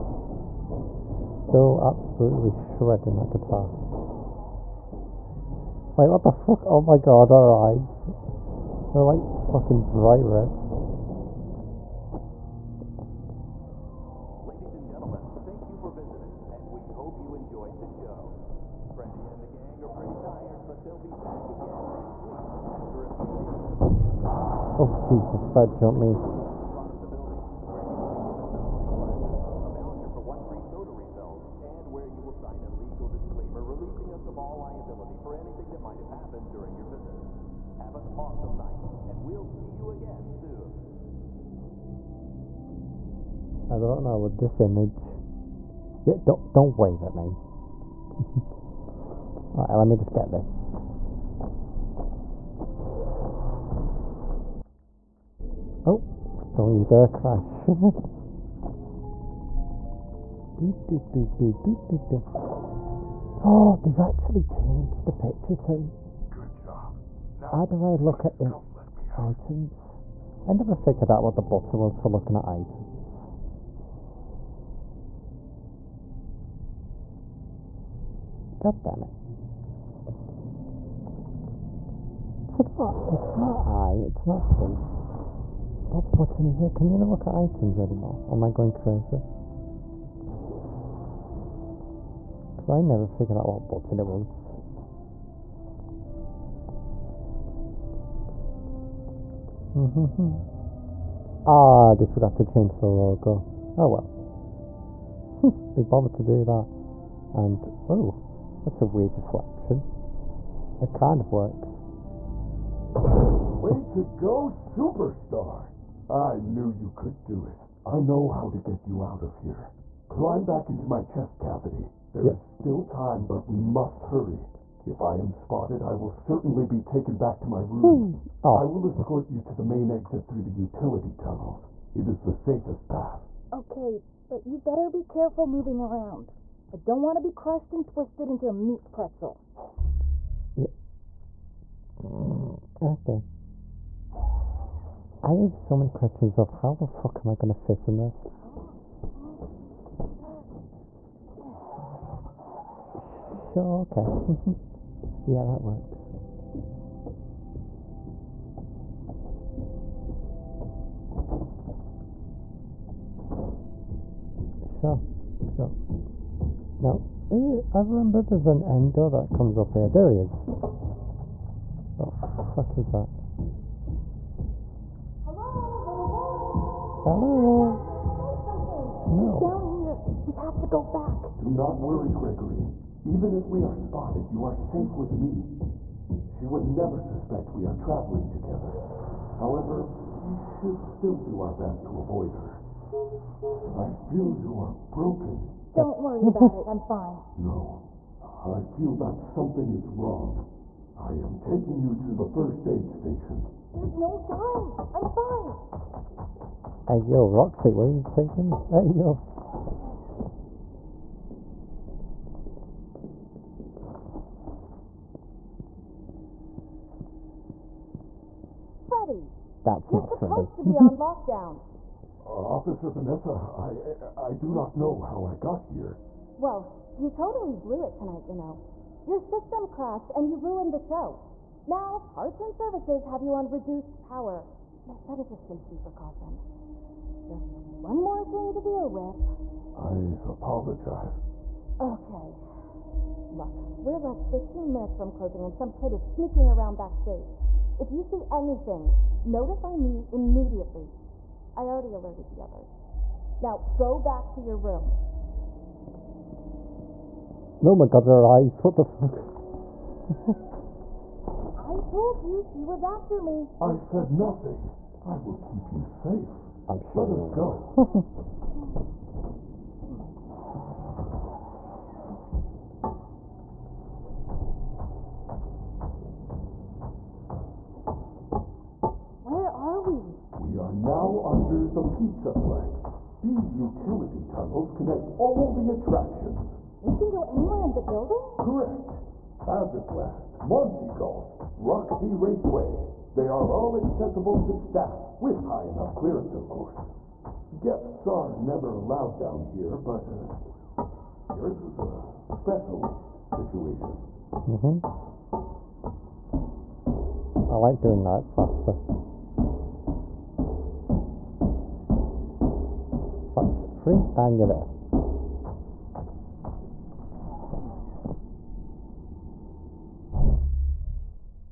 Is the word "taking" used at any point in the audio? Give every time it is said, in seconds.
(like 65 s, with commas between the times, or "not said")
201 s, 208 s.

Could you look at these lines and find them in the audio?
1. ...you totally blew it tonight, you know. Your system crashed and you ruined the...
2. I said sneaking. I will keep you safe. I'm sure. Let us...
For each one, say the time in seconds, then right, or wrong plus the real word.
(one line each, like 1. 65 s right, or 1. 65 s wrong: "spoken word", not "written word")
1. 226 s right
2. 263 s wrong: "nothing", not "sneaking".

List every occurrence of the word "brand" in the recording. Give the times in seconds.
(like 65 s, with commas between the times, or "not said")
not said.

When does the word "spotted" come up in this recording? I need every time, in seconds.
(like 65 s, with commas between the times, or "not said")
125 s, 183 s.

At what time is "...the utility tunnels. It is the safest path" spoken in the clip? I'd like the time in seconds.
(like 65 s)
130 s.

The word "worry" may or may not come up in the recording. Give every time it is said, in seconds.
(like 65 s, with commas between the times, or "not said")
181 s, 196 s.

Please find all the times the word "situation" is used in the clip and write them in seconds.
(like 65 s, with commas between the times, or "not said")
303 s.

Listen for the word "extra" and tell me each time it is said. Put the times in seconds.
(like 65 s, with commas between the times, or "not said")
not said.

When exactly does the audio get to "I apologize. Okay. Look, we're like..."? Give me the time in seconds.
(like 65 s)
239 s.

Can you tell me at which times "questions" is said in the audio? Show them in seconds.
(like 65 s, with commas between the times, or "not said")
145 s.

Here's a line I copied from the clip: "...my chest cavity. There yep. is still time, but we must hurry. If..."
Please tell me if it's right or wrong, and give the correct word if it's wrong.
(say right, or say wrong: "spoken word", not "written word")
right.